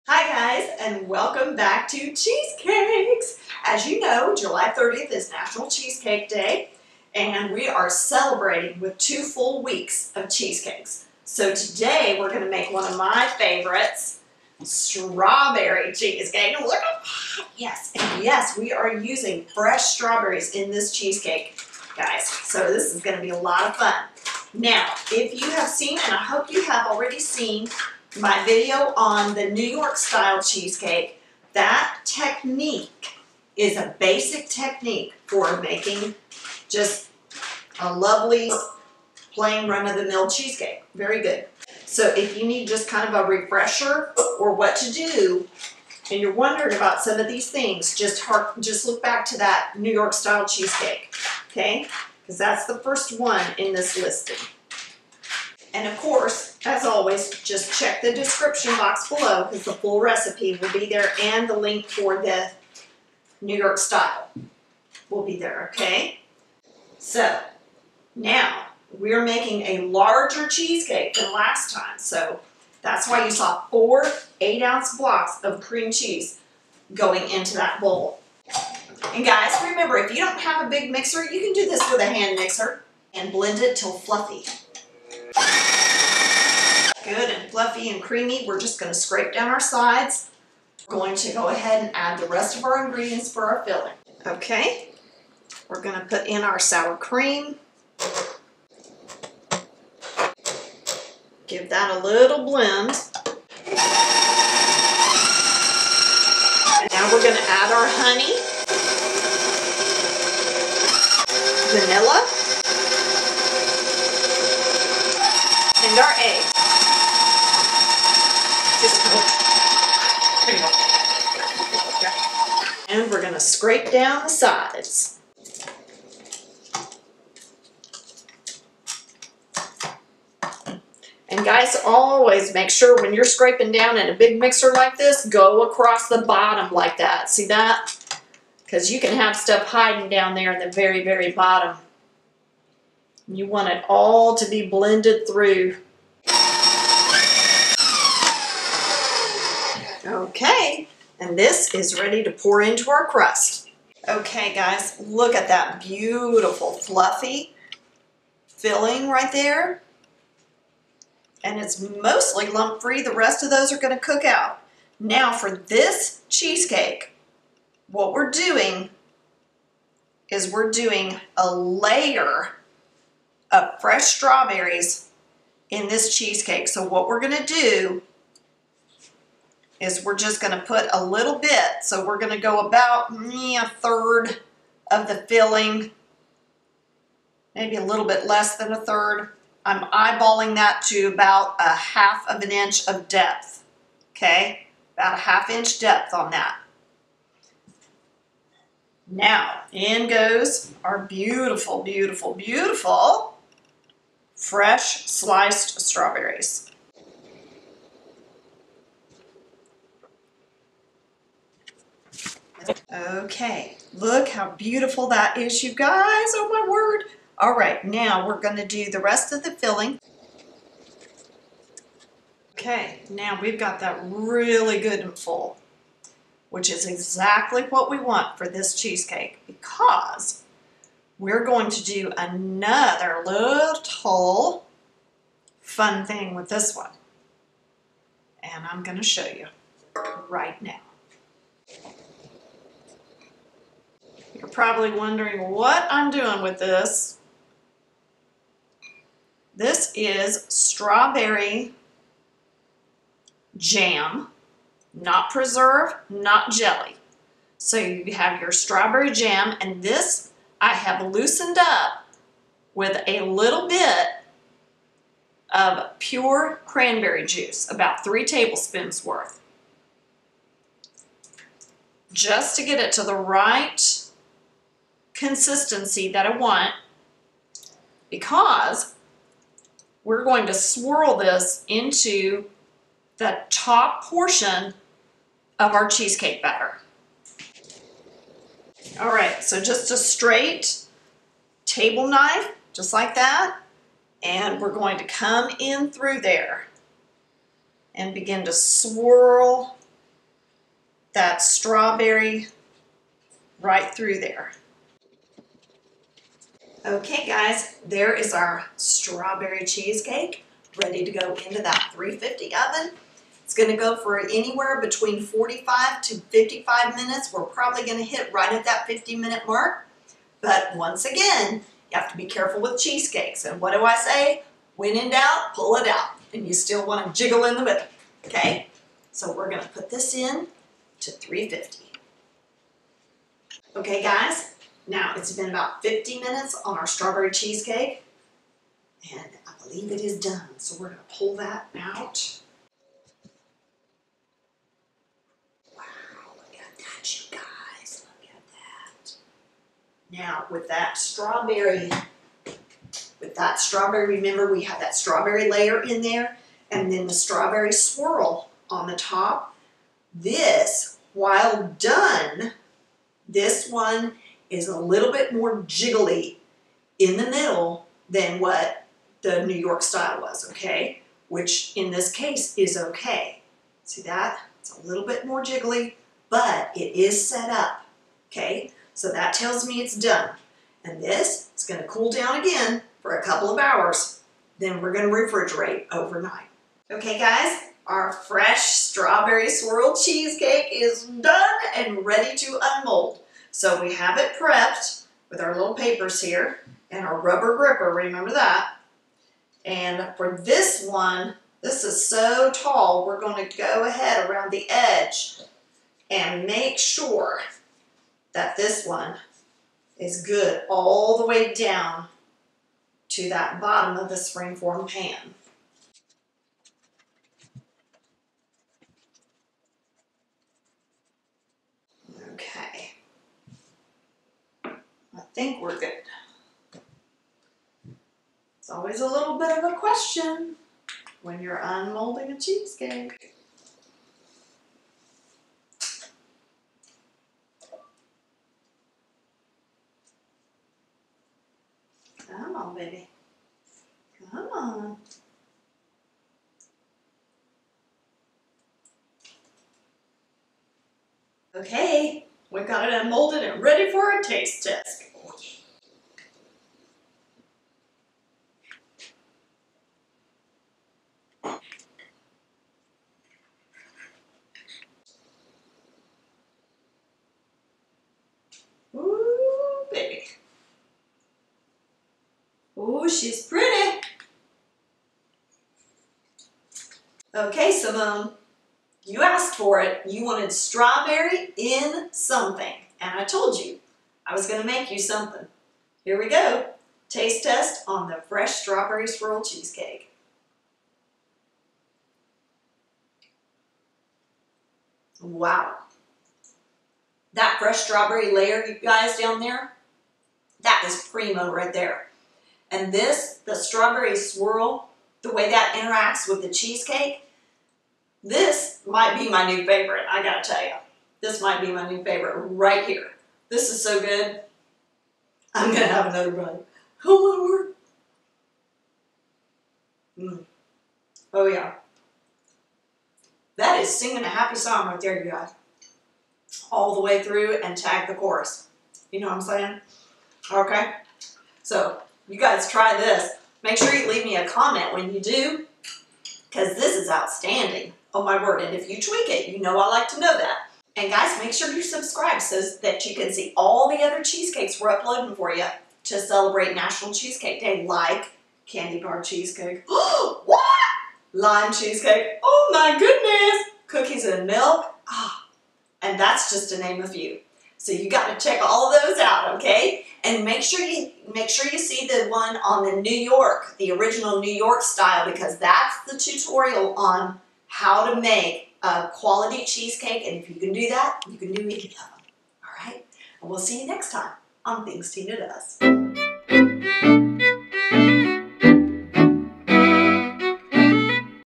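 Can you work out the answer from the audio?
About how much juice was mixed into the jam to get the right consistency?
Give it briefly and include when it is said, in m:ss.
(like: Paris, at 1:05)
3 tablespoons, at 4:28.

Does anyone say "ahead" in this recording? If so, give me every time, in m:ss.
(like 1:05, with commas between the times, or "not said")
1:31, 6:43.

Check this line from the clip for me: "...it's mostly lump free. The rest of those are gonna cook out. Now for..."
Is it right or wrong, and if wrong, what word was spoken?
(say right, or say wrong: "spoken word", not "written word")
right.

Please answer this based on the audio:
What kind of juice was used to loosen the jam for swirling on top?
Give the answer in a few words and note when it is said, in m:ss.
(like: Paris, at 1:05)
cranberry juice, at 4:26.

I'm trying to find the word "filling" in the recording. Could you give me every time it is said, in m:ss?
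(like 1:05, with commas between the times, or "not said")
1:33, 2:38, 3:05, 3:39.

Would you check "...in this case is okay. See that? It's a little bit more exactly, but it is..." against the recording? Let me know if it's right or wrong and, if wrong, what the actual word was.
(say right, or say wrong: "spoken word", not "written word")
wrong: "jiggly", not "exactly".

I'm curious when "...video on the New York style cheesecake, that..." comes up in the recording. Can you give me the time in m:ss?
0:28.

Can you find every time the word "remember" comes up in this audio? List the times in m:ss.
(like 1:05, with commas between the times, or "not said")
1:19, 5:54, 6:37.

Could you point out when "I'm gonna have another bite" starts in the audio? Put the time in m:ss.
8:35.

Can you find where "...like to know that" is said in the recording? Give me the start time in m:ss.
8:59.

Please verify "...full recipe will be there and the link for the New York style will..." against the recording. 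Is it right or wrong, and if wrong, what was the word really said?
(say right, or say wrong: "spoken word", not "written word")
right.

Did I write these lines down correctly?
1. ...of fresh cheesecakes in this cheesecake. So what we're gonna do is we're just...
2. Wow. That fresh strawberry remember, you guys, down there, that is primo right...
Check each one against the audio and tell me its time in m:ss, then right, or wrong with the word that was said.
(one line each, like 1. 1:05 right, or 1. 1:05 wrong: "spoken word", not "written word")
1. 2:53 wrong: "strawberries", not "cheesecakes"
2. 8:15 wrong: "layer", not "remember".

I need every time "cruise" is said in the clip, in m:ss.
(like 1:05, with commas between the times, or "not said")
not said.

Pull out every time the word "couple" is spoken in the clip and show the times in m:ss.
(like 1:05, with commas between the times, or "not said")
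6:23.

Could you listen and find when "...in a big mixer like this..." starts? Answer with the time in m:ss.
2:13.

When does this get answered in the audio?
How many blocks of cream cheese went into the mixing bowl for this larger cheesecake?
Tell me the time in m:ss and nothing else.
1:13.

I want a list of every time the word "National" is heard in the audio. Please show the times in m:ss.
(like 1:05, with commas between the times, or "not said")
0:05, 9:06.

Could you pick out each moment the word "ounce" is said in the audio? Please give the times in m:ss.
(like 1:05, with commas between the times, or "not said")
1:14.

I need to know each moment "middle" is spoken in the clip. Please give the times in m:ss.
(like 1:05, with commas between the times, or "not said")
5:27, 6:07.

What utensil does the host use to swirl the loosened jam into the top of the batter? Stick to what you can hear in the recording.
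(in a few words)
table knife.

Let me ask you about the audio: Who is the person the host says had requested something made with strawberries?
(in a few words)
Simone.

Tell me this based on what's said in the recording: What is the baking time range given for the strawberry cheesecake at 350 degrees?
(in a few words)
45 to 55 minutes.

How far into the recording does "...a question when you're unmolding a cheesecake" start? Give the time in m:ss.
7:09.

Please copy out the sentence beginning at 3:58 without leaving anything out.
And I'm gonna show you right now.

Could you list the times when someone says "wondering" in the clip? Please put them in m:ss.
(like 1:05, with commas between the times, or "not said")
0:46, 4:04.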